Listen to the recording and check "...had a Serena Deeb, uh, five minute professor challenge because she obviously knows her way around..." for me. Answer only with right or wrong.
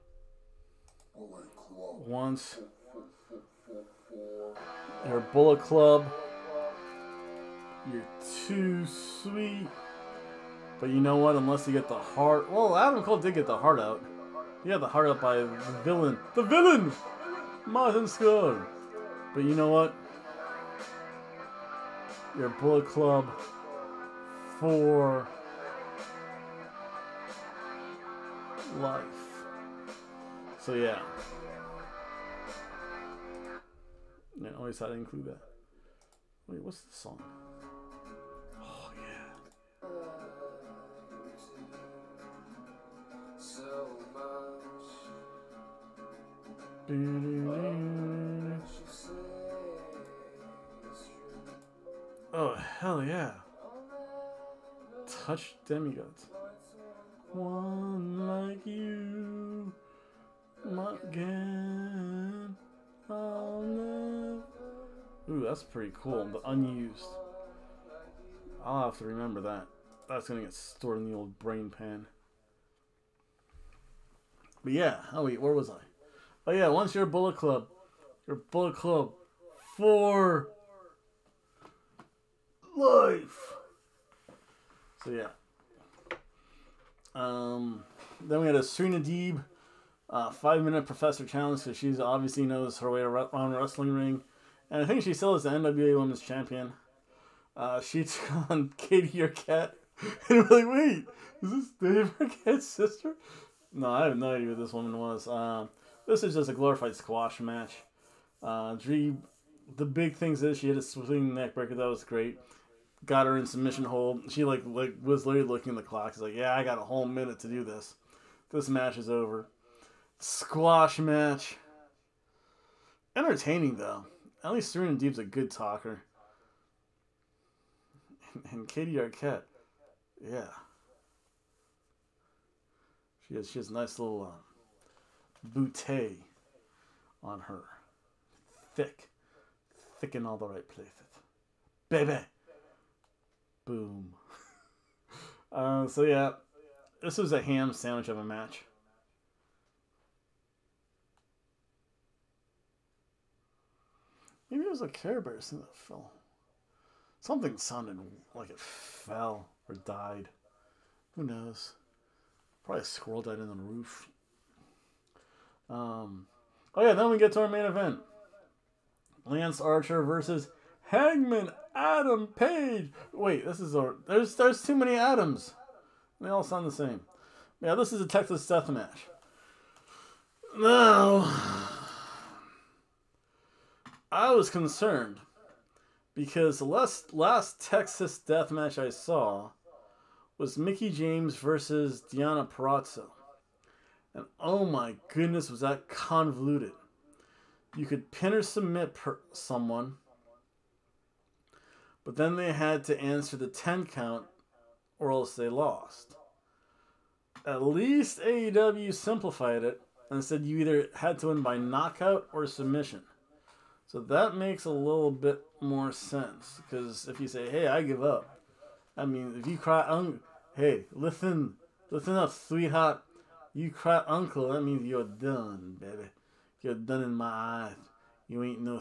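right.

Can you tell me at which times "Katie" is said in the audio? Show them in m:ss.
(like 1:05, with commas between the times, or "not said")
1:38, 2:08.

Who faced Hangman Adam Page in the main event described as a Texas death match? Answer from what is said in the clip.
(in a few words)
Lance Archer.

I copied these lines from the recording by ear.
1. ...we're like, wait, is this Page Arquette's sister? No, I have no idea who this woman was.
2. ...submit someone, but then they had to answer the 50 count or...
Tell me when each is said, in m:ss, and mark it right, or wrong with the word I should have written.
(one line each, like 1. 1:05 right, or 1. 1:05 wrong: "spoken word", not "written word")
1. 1:40 wrong: "Dave", not "Page"
2. 3:18 wrong: "10", not "50".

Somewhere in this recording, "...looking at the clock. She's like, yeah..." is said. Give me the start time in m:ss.
1:55.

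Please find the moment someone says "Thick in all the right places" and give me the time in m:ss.
2:19.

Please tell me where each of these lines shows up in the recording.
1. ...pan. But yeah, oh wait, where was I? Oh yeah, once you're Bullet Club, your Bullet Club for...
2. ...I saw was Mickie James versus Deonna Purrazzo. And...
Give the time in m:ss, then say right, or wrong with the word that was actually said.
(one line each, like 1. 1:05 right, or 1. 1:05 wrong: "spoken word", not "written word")
1. 1:11 right
2. 3:08 right.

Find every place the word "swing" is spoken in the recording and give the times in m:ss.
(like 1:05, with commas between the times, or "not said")
1:50.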